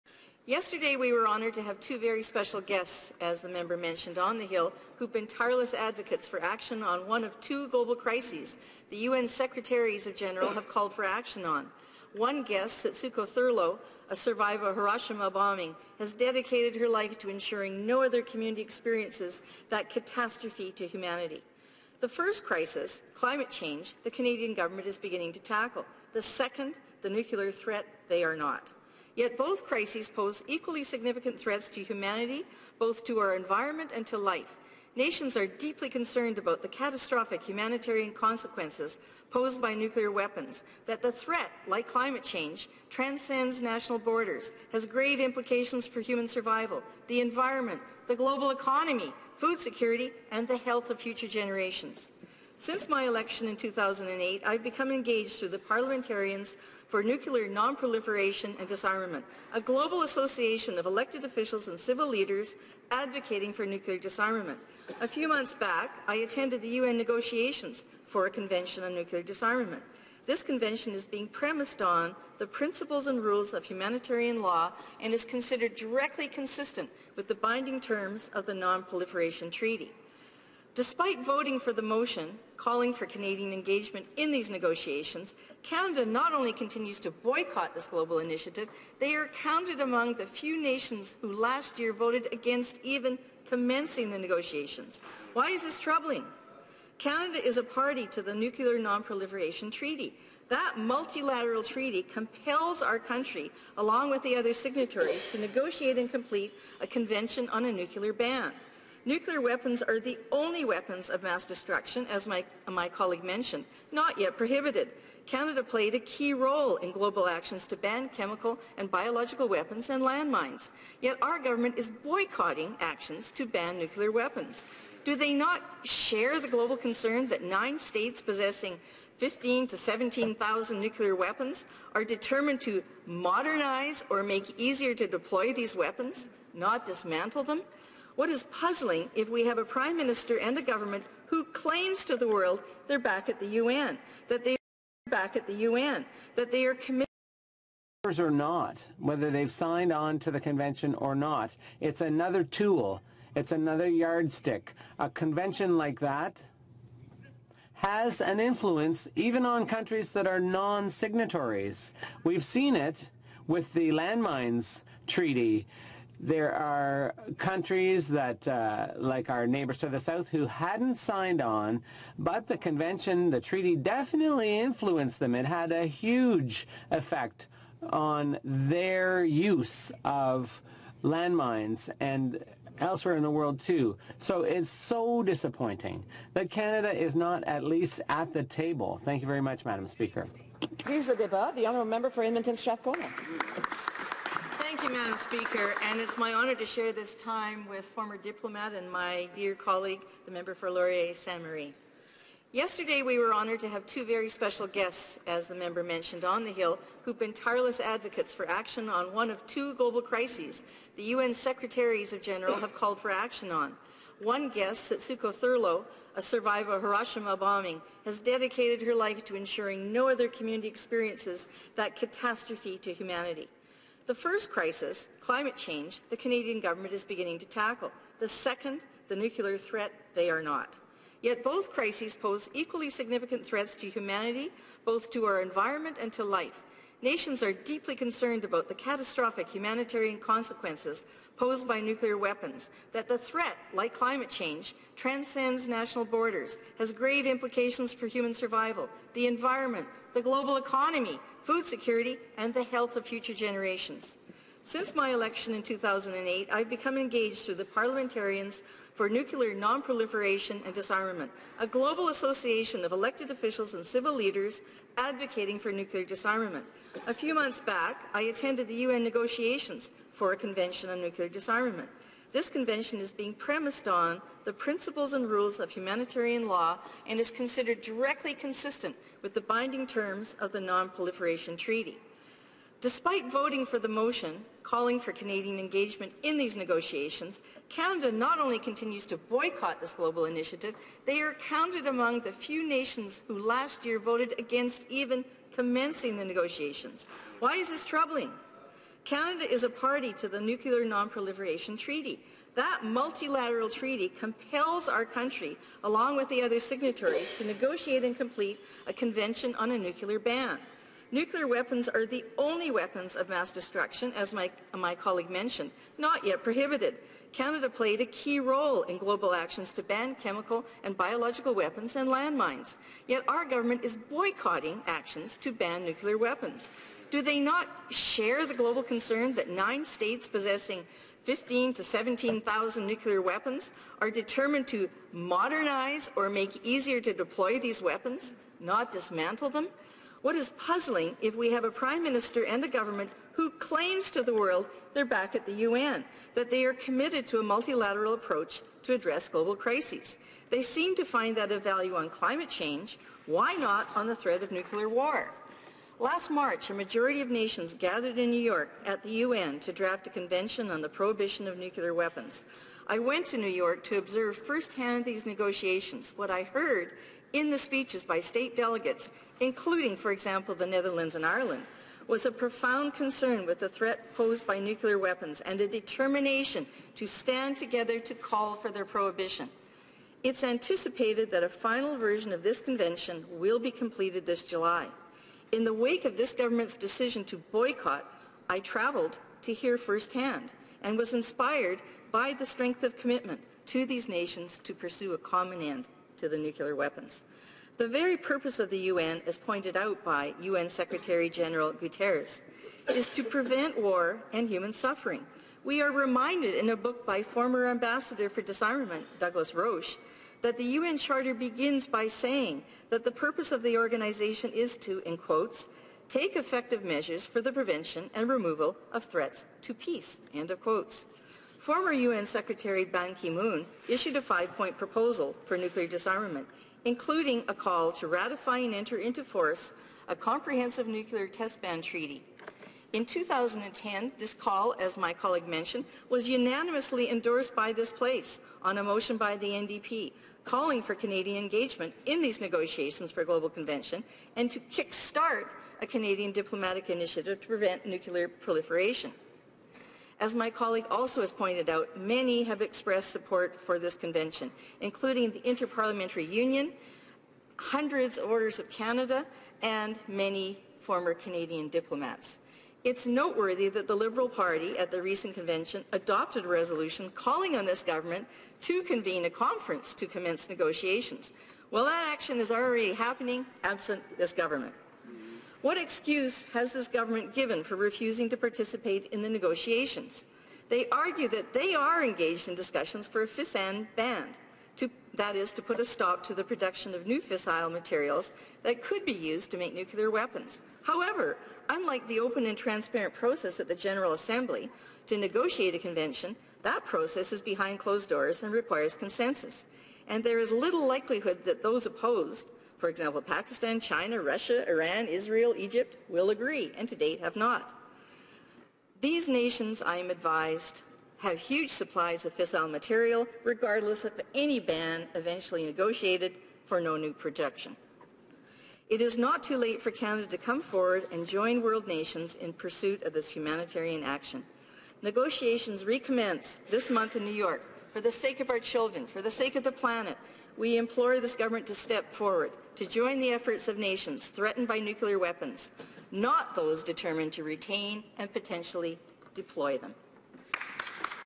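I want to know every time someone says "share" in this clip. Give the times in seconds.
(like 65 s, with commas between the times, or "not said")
125 s, 196 s, 327 s.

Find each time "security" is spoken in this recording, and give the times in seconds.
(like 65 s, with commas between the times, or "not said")
49 s, 251 s.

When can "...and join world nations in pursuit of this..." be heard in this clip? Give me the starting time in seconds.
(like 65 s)
521 s.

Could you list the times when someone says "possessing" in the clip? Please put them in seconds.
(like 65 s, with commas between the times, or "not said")
128 s, 330 s.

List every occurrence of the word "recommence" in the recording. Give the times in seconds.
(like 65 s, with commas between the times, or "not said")
525 s.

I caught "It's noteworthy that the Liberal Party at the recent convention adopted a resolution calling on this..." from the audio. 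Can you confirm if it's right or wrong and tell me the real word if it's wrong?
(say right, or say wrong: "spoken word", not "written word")
right.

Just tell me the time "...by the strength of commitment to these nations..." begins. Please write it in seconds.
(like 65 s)
392 s.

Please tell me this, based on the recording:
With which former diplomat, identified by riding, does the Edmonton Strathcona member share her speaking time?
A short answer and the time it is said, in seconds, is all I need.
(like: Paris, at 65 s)
Laurier Saint Marie, at 200 s.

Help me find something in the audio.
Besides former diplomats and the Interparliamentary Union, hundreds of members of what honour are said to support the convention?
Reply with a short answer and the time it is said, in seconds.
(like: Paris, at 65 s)
Orders of Canada, at 458 s.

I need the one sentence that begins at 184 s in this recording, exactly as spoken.
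So it's so disappointing that Canada is not at least at the table.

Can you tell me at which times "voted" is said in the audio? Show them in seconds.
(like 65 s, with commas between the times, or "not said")
91 s, 293 s.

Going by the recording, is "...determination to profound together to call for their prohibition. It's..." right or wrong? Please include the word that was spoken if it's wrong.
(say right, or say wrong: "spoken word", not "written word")
wrong: "stand", not "profound".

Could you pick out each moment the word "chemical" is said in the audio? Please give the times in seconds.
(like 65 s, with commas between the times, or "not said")
118 s, 320 s.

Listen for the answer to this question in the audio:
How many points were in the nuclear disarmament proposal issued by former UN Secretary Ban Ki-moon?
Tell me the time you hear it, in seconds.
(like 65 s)
424 s.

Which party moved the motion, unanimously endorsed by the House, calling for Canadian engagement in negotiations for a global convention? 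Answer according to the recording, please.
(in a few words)
NDP.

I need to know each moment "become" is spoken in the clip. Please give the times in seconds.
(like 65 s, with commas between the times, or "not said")
54 s, 256 s.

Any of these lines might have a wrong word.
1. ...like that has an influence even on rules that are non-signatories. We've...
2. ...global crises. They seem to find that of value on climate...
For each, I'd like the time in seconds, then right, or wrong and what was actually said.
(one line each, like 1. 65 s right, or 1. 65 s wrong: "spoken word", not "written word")
1. 155 s wrong: "countries", not "rules"
2. 349 s right.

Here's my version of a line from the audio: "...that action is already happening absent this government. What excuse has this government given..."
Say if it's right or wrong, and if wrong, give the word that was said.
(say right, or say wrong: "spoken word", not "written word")
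right.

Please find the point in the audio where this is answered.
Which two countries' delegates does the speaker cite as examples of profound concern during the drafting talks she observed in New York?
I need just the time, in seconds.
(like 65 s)
370 s.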